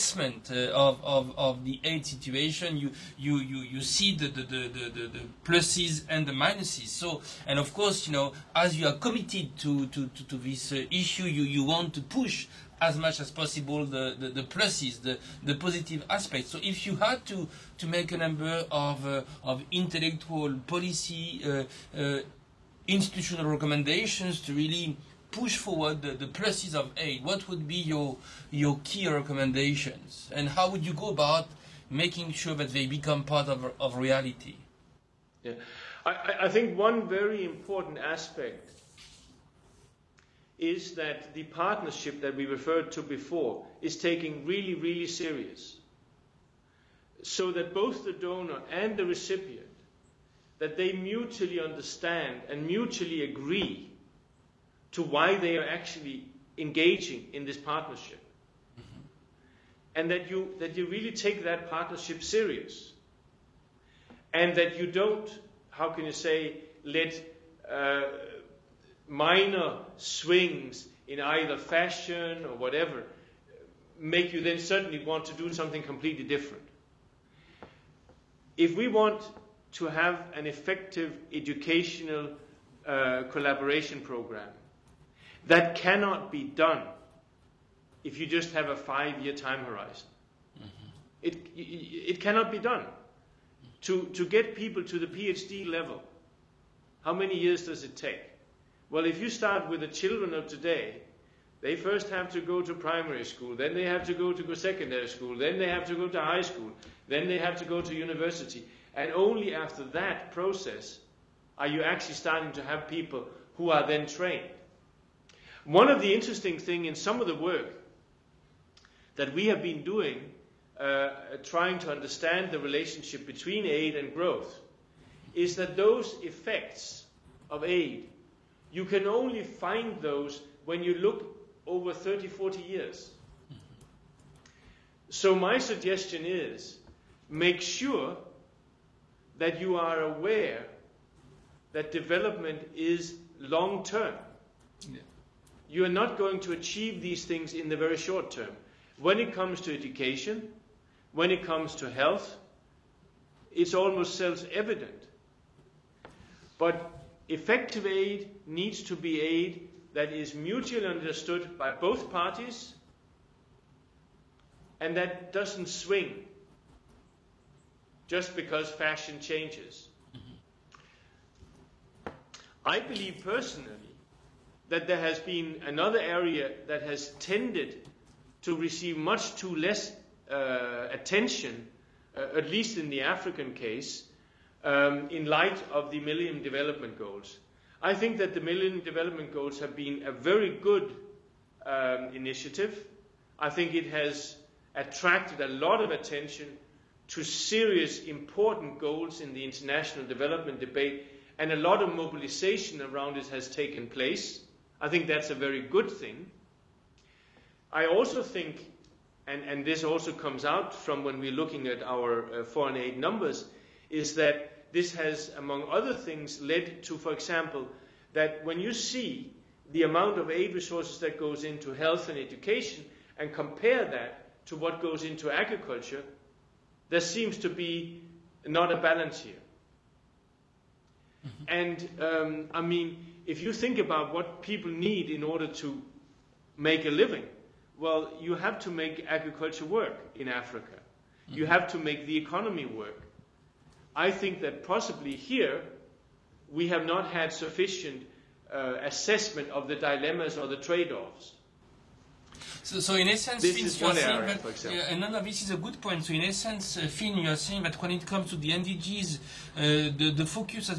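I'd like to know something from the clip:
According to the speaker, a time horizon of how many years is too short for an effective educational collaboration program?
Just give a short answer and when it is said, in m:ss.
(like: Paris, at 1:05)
5, at 1:28.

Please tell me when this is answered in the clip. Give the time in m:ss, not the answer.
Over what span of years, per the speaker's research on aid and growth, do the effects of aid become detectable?
2:11.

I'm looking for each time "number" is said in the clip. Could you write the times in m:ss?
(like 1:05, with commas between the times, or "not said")
0:18, 3:32.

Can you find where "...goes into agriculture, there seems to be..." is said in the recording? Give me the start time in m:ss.
3:44.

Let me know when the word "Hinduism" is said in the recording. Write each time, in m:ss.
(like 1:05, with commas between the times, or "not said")
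not said.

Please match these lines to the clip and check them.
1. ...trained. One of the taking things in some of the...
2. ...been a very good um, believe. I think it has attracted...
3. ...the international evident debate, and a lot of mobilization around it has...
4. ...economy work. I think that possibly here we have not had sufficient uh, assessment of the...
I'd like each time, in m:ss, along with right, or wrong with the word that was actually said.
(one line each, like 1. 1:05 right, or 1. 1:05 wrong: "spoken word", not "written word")
1. 1:54 wrong: "interesting", not "taking"
2. 3:09 wrong: "initiative", not "believe"
3. 3:19 wrong: "development", not "evident"
4. 4:02 right.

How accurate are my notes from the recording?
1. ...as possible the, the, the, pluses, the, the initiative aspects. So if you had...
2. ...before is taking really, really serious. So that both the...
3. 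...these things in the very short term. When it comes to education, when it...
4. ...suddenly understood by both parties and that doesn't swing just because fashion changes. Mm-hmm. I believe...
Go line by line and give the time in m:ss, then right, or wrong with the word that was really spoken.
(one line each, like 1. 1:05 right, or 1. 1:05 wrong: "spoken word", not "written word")
1. 0:13 wrong: "positive", not "initiative"
2. 0:43 right
3. 2:26 right
4. 2:40 wrong: "mutually", not "suddenly".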